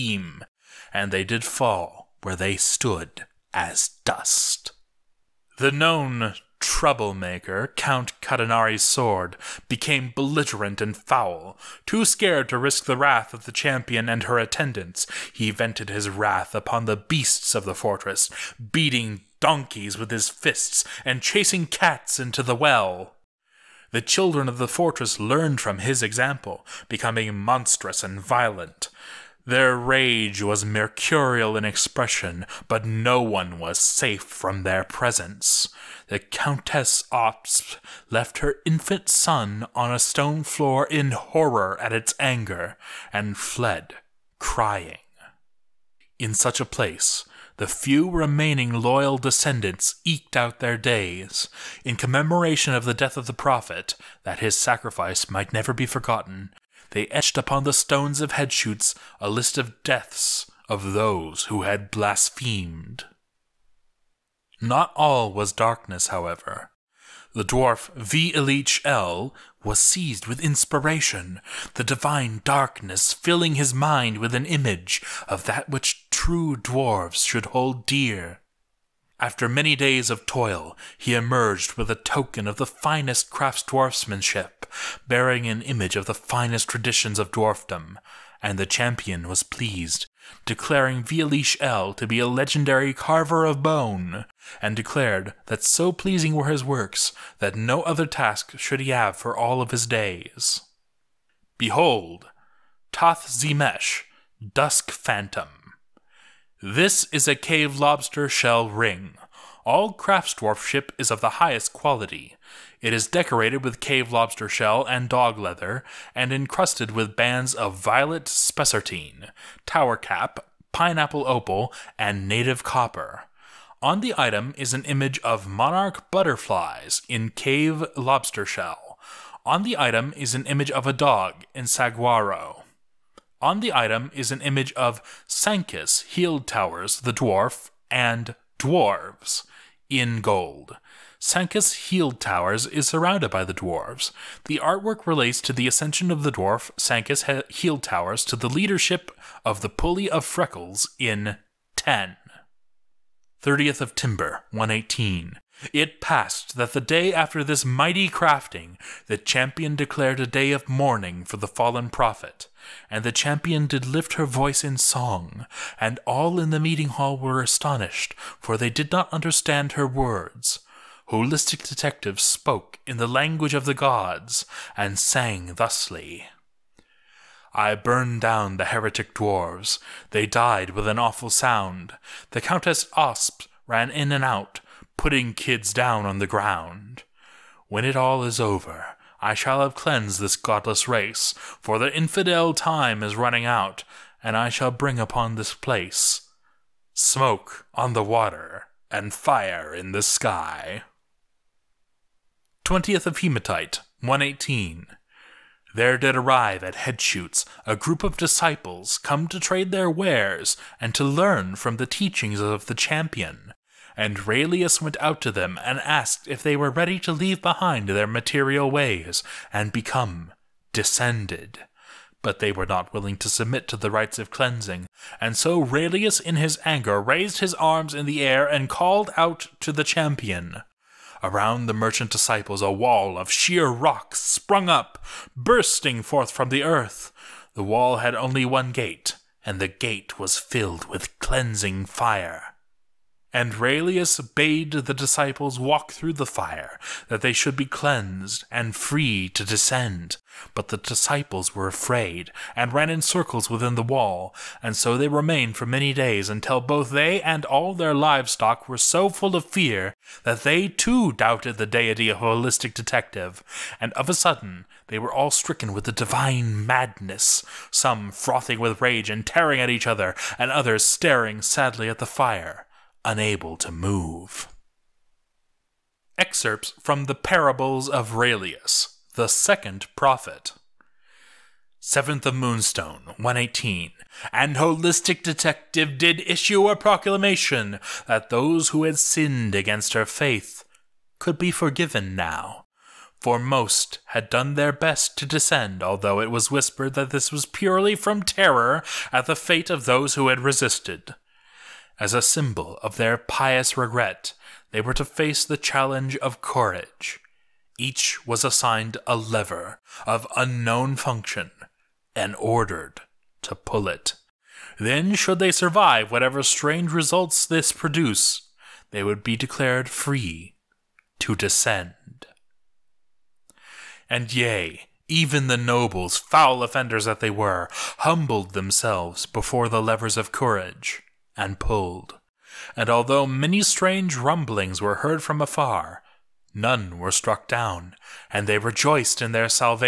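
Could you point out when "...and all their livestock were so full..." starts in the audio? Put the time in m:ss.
4:17.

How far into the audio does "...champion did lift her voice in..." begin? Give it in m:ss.
2:43.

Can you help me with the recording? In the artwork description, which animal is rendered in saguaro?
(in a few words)
a dog.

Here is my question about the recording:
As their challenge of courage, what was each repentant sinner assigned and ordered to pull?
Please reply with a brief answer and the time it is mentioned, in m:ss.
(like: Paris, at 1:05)
a lever, at 5:09.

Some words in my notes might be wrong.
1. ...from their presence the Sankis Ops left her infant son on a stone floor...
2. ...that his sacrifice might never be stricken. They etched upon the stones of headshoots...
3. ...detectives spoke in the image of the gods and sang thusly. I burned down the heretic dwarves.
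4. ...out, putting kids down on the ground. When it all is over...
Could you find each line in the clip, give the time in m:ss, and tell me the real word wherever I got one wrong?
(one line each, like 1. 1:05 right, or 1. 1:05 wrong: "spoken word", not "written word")
1. 0:34 wrong: "Countess", not "Sankis"
2. 0:54 wrong: "forgotten", not "stricken"
3. 2:51 wrong: "language", not "image"
4. 3:04 right.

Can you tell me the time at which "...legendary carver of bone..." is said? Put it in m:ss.
1:32.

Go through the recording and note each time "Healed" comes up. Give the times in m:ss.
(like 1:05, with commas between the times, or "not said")
2:16, 2:21, 2:27.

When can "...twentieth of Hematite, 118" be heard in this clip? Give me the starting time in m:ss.
3:22.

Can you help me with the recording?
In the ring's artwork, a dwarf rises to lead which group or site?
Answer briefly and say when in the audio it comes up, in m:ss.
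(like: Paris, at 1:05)
Pulley of Freckles, at 2:29.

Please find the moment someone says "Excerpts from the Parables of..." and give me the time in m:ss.
4:36.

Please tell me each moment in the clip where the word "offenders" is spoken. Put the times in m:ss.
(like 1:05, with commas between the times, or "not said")
5:26.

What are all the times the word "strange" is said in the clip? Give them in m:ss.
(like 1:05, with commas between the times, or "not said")
5:16, 5:33.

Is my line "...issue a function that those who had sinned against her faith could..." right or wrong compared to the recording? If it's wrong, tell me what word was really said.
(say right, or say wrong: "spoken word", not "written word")
wrong: "proclamation", not "function".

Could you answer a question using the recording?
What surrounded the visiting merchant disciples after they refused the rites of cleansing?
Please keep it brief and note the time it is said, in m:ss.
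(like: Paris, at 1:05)
a wall of sheer rock, at 3:52.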